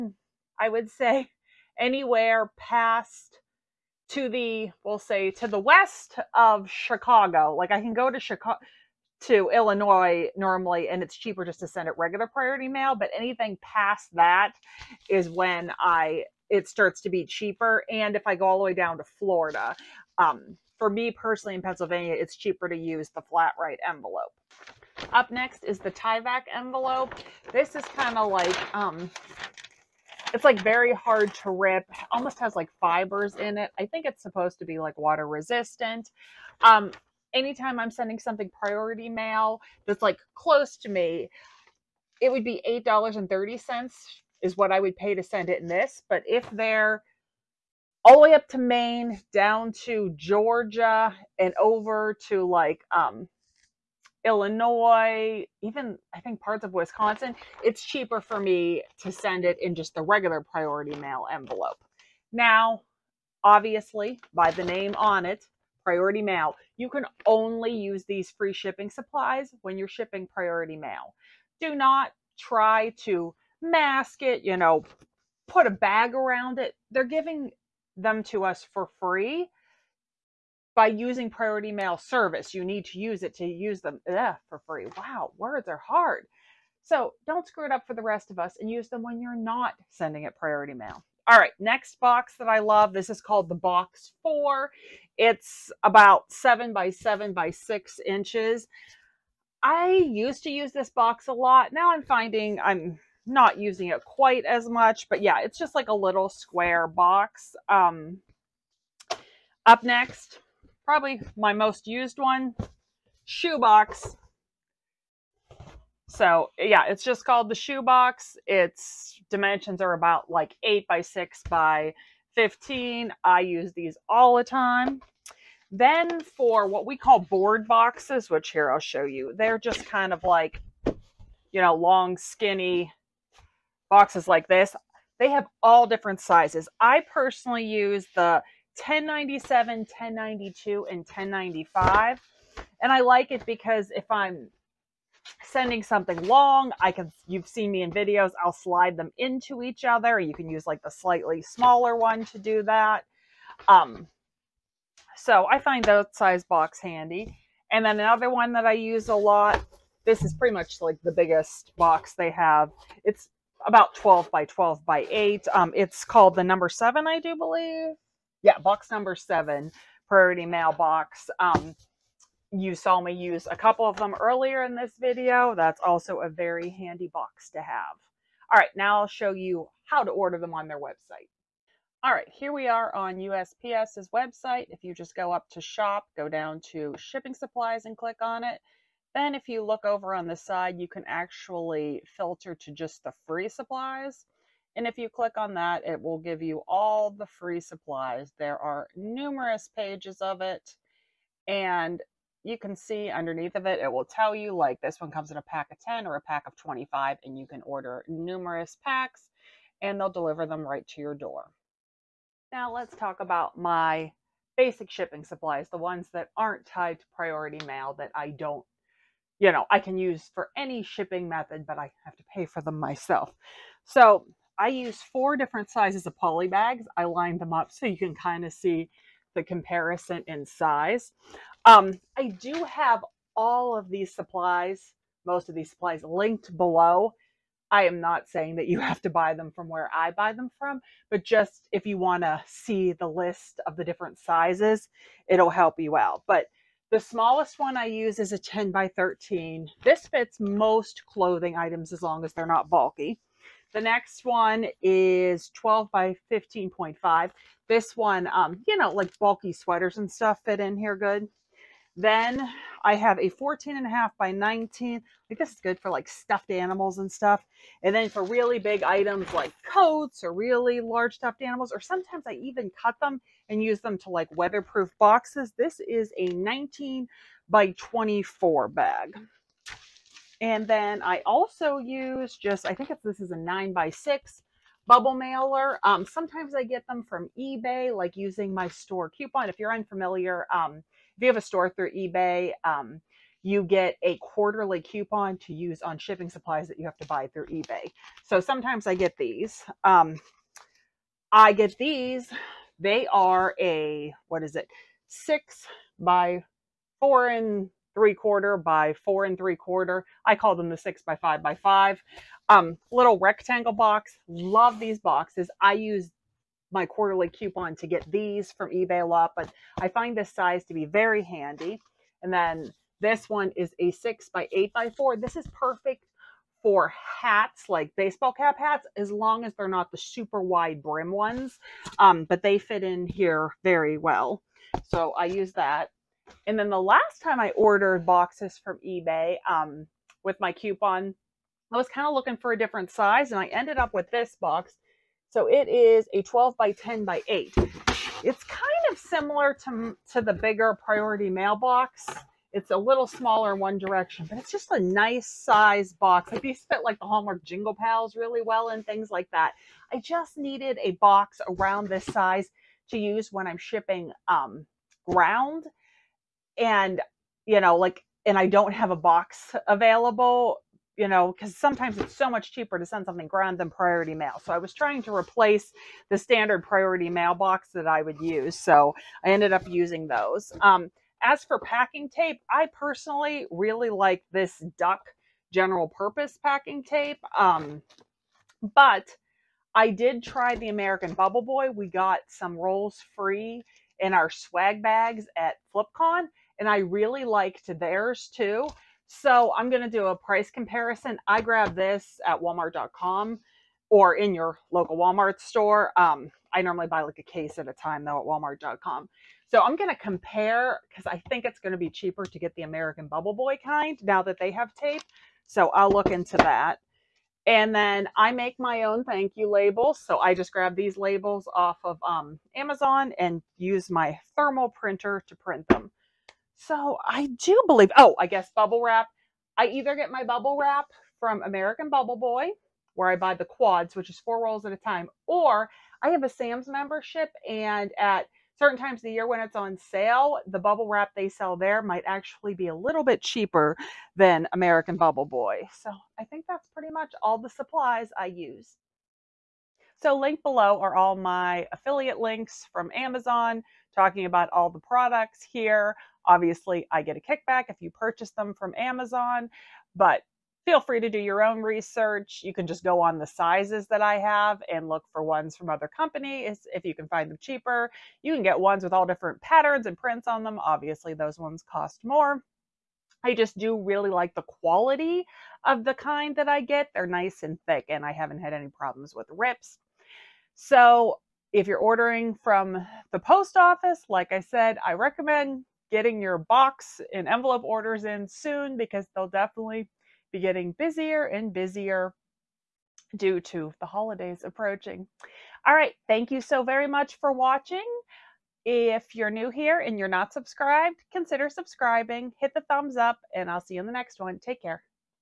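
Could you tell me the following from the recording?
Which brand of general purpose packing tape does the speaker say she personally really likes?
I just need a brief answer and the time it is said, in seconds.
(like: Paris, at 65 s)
Duck, at 384 s.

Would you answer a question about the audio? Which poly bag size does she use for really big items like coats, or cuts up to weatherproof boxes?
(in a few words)
19 by 24.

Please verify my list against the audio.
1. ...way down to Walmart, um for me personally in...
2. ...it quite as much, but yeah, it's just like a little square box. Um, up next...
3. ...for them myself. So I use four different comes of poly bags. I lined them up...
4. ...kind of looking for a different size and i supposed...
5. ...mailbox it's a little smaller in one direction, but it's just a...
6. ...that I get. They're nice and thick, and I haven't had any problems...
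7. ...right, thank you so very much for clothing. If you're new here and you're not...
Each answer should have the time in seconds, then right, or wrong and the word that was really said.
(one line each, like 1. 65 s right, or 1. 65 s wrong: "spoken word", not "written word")
1. 18 s wrong: "Florida", not "Walmart"
2. 103 s right
3. 222 s wrong: "sizes", not "comes"
4. 341 s wrong: "ended", not "supposed"
5. 351 s right
6. 476 s right
7. 495 s wrong: "watching", not "clothing".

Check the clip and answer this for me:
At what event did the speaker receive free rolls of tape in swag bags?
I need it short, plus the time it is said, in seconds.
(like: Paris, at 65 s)
FlipCon, at 395 s.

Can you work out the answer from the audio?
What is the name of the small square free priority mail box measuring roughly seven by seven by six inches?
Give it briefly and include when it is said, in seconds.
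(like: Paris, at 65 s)
Box 4, at 93 s.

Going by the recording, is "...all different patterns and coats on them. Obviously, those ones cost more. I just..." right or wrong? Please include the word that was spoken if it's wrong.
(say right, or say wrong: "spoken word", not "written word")
wrong: "prints", not "coats".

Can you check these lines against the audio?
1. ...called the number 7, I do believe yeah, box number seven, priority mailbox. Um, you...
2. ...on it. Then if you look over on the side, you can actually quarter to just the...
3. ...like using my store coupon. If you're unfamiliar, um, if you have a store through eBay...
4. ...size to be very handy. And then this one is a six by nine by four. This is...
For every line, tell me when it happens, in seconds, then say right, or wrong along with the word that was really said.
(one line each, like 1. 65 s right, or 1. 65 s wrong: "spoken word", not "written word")
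1. 166 s right
2. 188 s wrong: "filter", not "quarter"
3. 287 s right
4. 320 s wrong: "eight", not "nine".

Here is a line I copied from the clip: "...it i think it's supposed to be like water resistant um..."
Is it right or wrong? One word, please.
right.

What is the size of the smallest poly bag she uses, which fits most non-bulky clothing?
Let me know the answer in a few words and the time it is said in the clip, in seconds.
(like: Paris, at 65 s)
10 by 13, at 248 s.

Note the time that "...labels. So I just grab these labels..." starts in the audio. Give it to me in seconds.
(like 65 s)
419 s.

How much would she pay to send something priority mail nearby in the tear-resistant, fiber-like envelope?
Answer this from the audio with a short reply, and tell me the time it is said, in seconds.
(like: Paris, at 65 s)
$8.30, at 42 s.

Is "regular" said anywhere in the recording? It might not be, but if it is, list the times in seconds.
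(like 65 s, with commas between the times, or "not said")
11 s, 60 s.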